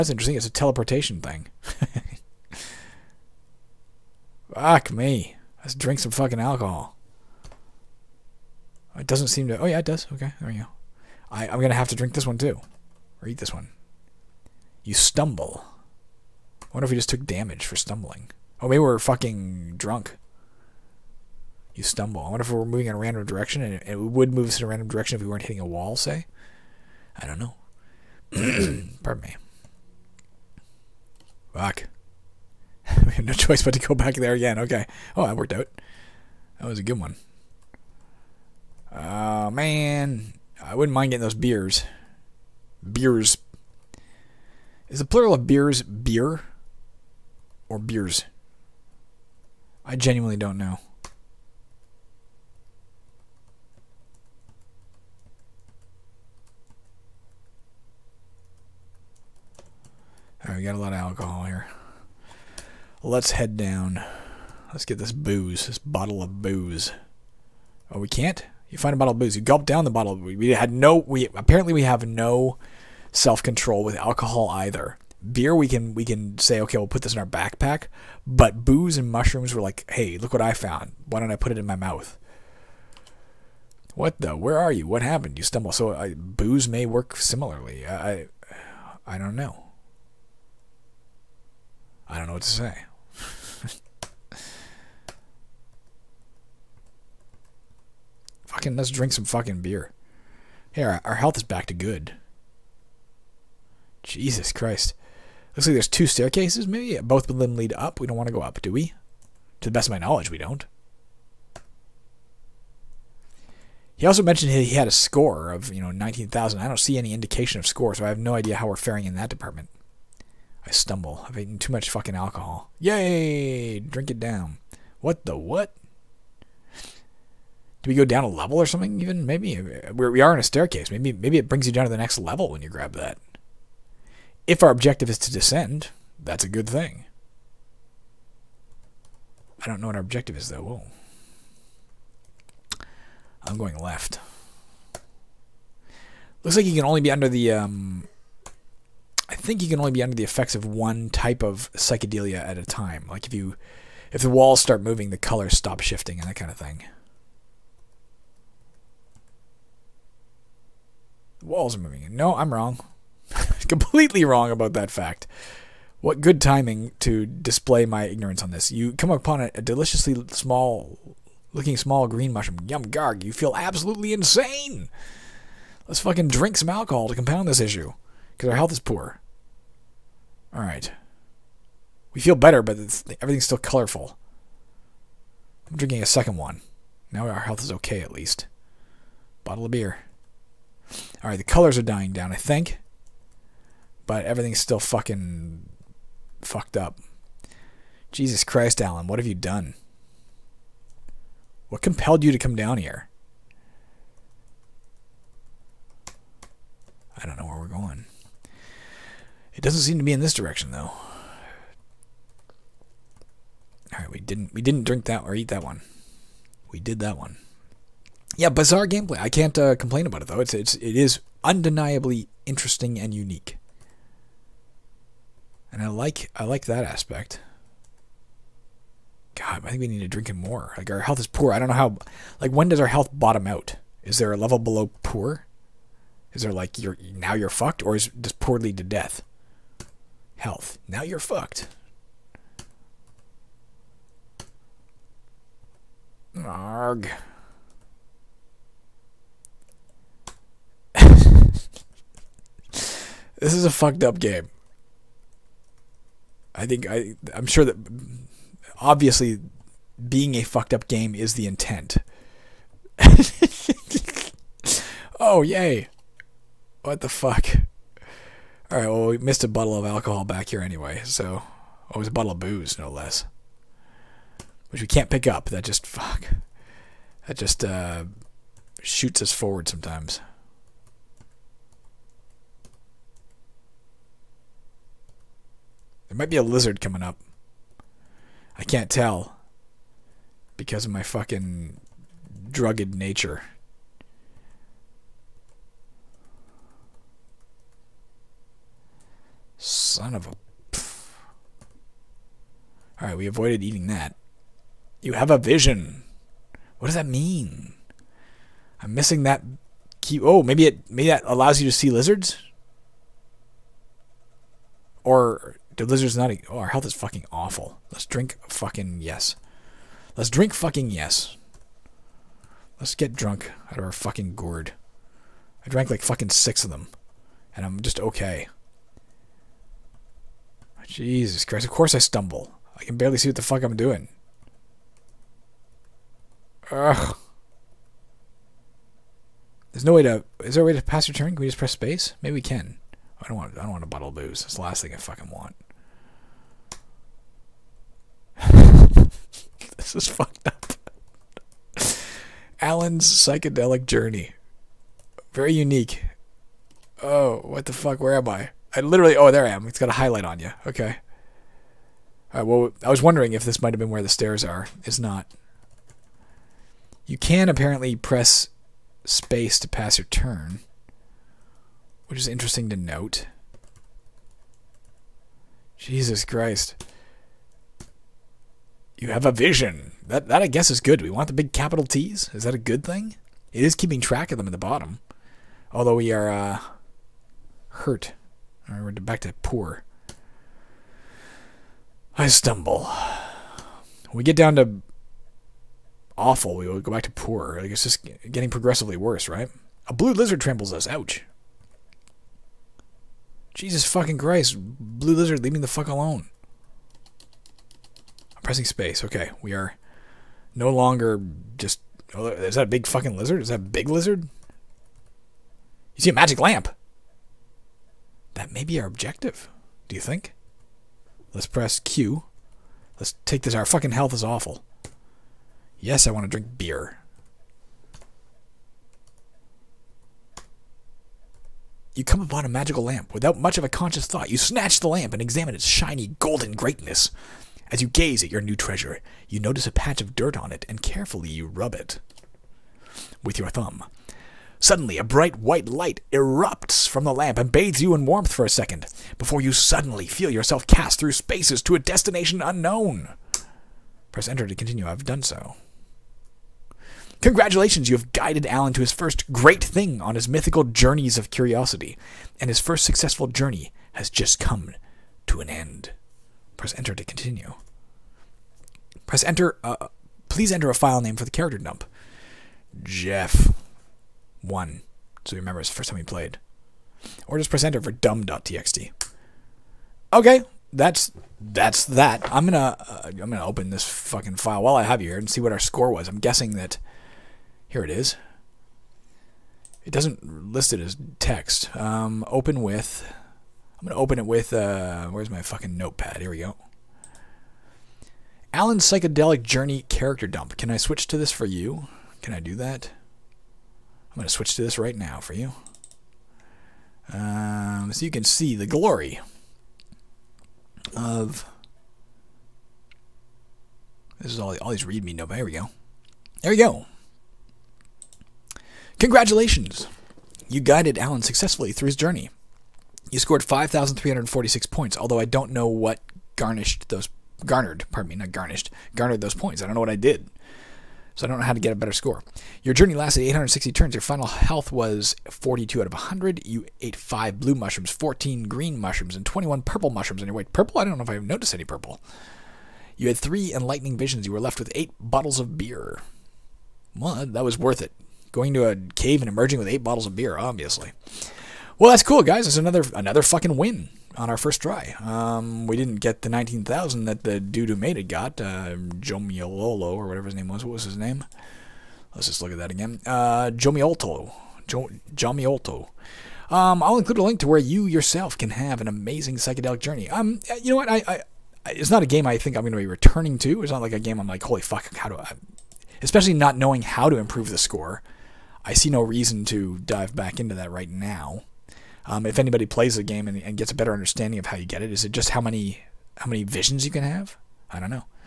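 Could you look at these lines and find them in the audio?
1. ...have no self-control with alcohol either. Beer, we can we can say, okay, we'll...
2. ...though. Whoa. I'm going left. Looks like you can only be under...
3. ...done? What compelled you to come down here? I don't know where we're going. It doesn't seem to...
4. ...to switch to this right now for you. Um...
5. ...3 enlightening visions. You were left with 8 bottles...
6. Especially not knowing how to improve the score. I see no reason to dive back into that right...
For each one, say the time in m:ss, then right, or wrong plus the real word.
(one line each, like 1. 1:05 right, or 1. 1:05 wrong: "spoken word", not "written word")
1. 1:11 right
2. 2:20 right
3. 3:19 right
4. 8:24 right
5. 9:03 right
6. 9:36 right.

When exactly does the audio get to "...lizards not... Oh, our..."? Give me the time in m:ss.
5:15.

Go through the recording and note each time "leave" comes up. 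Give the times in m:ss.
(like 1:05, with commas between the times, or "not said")
6:45.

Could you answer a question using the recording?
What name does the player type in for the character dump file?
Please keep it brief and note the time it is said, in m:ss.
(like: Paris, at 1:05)
Jeff, at 7:52.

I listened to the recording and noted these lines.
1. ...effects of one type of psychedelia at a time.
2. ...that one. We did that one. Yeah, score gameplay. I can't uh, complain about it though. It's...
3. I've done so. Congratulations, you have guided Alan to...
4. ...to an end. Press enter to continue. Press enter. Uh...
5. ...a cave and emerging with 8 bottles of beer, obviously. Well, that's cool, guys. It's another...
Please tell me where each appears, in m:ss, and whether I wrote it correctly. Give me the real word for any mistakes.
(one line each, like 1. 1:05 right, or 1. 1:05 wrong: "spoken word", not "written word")
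1. 2:30 right
2. 3:35 wrong: "bizarre", not "score"
3. 7:34 right
4. 7:45 right
5. 9:08 right.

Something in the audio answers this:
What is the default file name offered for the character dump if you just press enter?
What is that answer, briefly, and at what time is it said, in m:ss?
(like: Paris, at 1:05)
dumb.txt, at 7:57.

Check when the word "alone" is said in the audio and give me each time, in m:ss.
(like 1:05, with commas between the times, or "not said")
6:45.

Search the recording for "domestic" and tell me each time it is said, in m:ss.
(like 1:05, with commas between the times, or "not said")
not said.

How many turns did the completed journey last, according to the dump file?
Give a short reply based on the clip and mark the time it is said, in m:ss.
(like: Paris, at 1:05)
860, at 8:53.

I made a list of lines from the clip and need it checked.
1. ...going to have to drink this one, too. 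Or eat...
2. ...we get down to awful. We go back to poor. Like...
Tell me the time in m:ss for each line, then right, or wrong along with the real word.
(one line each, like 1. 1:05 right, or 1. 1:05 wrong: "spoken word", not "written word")
1. 0:11 right
2. 6:34 right.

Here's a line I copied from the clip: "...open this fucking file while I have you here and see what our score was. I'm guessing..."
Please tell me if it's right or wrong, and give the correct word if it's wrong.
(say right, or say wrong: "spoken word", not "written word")
right.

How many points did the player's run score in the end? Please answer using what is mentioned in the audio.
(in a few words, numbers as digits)
5346.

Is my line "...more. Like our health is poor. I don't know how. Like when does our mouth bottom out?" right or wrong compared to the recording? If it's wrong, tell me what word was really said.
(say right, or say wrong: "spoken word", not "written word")
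wrong: "health", not "mouth".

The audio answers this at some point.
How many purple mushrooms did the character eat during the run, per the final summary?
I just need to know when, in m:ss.
8:59.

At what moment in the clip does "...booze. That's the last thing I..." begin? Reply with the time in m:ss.
5:44.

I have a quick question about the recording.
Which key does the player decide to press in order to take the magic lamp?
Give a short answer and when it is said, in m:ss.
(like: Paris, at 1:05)
Q, at 7:01.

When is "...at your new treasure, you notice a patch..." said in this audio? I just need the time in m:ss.
7:18.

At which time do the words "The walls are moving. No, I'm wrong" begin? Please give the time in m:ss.
2:41.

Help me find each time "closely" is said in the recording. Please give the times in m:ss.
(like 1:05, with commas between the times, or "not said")
not said.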